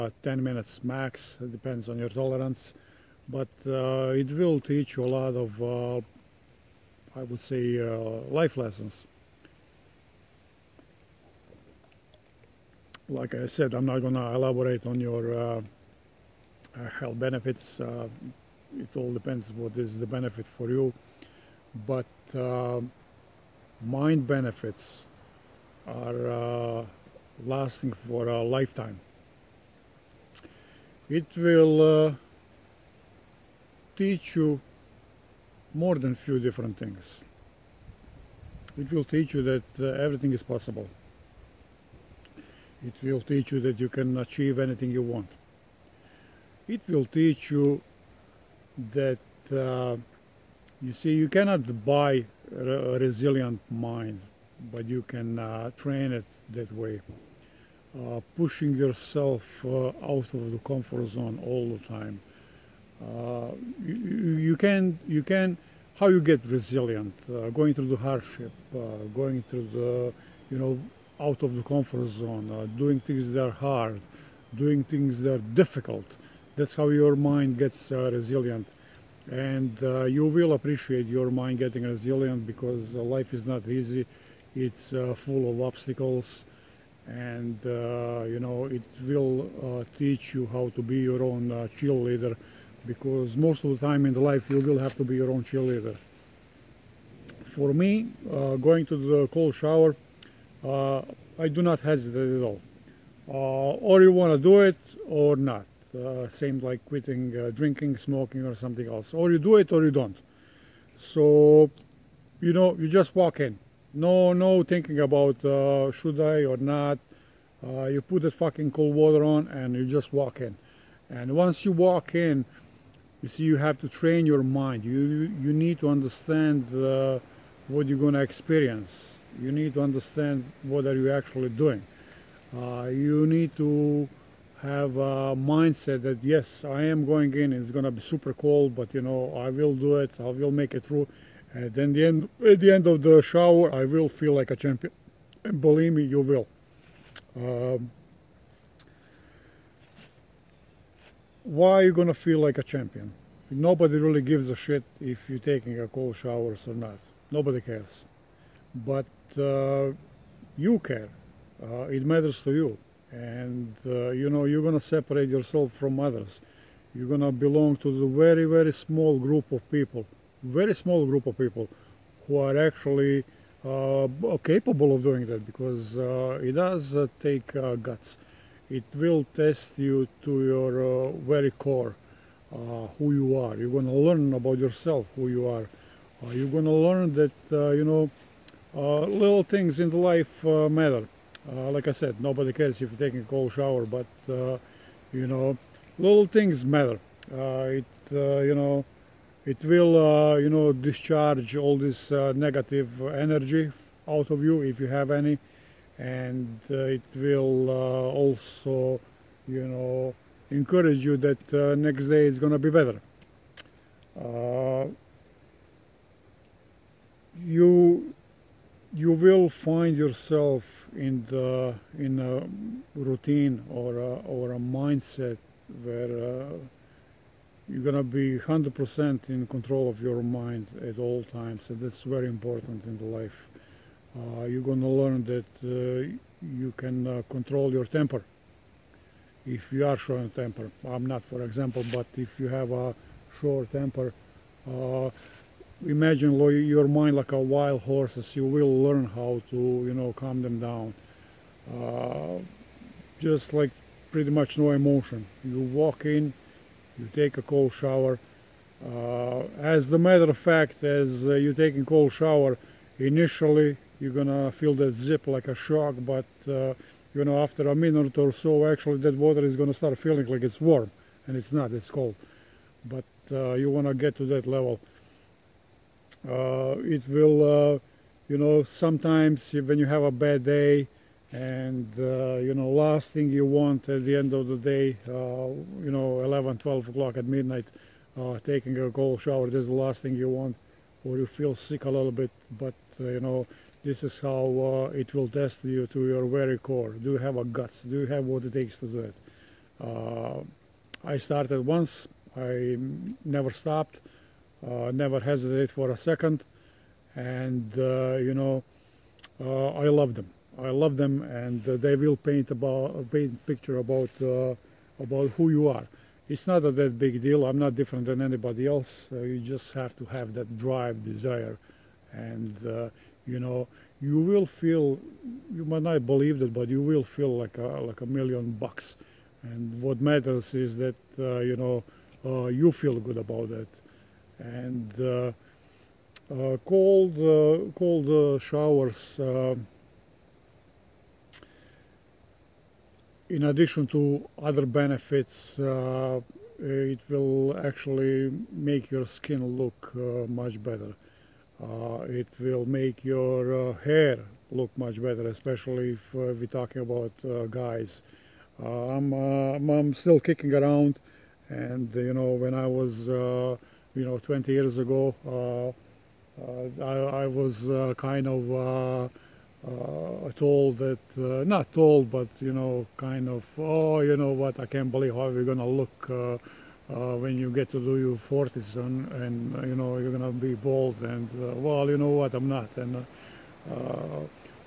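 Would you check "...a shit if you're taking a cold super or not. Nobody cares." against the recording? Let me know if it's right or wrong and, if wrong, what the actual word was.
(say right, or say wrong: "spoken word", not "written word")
wrong: "shower", not "super".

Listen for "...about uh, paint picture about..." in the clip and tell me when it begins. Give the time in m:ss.
5:12.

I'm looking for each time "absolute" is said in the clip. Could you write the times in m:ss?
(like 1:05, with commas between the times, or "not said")
not said.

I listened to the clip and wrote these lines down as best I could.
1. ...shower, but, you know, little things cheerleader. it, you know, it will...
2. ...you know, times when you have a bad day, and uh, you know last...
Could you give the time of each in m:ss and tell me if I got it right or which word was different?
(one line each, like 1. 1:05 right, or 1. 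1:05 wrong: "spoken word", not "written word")
1. 3:13 wrong: "matter", not "cheerleader"
2. 4:38 wrong: "sometimes", not "times".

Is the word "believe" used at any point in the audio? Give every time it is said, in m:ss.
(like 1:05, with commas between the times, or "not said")
2:25, 5:26, 6:14.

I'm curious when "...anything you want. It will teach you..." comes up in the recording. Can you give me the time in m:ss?
0:44.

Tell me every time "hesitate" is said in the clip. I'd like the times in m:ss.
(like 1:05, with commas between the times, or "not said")
1:41, 5:05.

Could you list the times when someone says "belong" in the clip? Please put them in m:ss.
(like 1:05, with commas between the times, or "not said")
2:47.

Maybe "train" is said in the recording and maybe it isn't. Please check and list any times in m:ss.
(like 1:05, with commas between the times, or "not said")
0:55, 2:03.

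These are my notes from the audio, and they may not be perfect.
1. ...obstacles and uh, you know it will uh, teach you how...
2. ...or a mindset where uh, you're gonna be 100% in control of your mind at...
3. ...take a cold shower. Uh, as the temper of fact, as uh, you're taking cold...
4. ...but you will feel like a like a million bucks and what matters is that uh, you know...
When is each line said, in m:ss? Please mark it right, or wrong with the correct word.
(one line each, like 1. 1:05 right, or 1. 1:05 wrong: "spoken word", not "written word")
1. 1:25 right
2. 3:44 right
3. 4:17 wrong: "matter", not "temper"
4. 5:26 right.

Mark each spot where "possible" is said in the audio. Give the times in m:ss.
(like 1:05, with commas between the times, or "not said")
0:40.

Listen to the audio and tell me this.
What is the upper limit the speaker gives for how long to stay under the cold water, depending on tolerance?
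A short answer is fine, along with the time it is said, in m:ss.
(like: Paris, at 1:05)
10 minutes, at 0:00.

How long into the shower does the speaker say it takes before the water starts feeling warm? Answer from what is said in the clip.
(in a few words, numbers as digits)
a minute.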